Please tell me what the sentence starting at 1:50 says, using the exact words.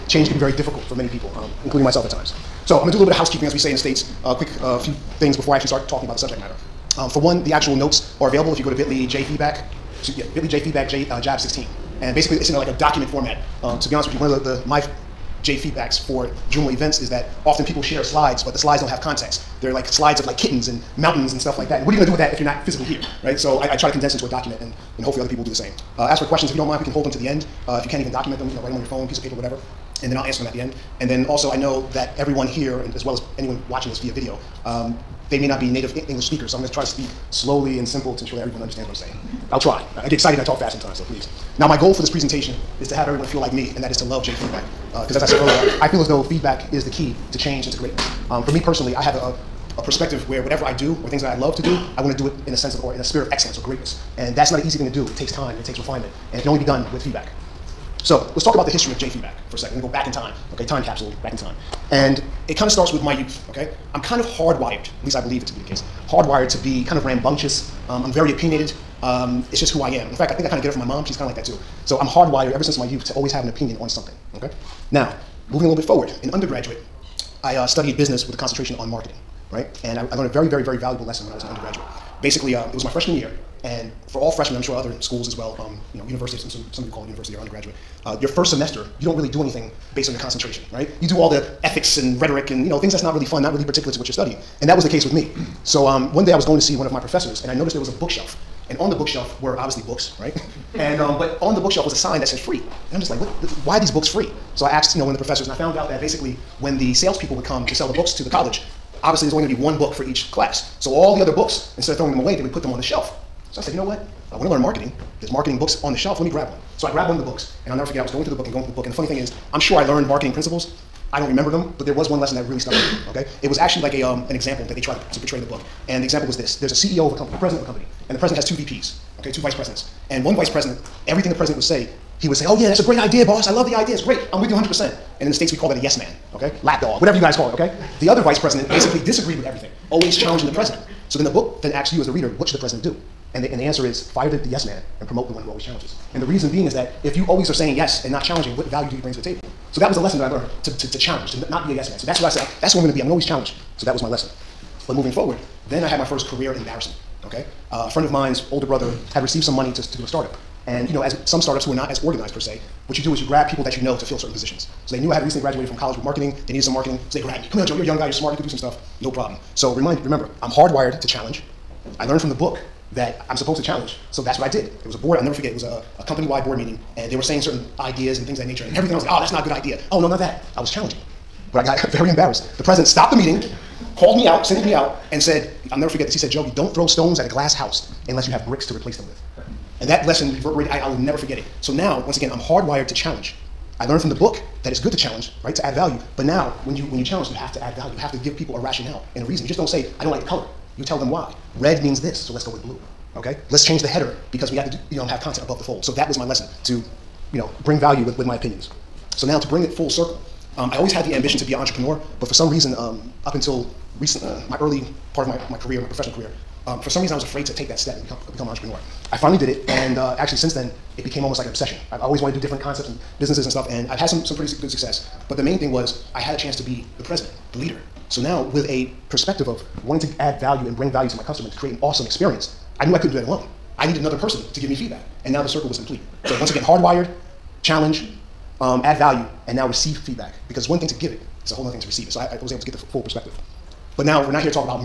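So all the other books, instead of throwing them away, they would put them on the shelf.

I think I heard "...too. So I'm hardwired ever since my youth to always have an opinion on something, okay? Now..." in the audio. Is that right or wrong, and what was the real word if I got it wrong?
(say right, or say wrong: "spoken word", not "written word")
right.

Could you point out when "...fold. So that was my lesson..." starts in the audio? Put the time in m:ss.
3:25.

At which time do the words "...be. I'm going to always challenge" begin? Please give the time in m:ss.
2:32.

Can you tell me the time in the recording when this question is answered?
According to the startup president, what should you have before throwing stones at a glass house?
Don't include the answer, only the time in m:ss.
3:08.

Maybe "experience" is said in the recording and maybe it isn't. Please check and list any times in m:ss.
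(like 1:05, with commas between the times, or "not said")
3:52.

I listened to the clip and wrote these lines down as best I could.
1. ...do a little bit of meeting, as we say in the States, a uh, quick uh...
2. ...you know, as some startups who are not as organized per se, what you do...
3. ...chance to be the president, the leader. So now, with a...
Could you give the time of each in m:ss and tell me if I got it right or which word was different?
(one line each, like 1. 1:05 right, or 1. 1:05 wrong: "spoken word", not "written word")
1. 0:02 wrong: "housekeeping", not "meeting"
2. 2:40 right
3. 3:46 right.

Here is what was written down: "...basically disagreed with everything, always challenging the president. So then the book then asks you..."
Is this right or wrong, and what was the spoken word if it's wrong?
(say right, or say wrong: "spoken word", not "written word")
right.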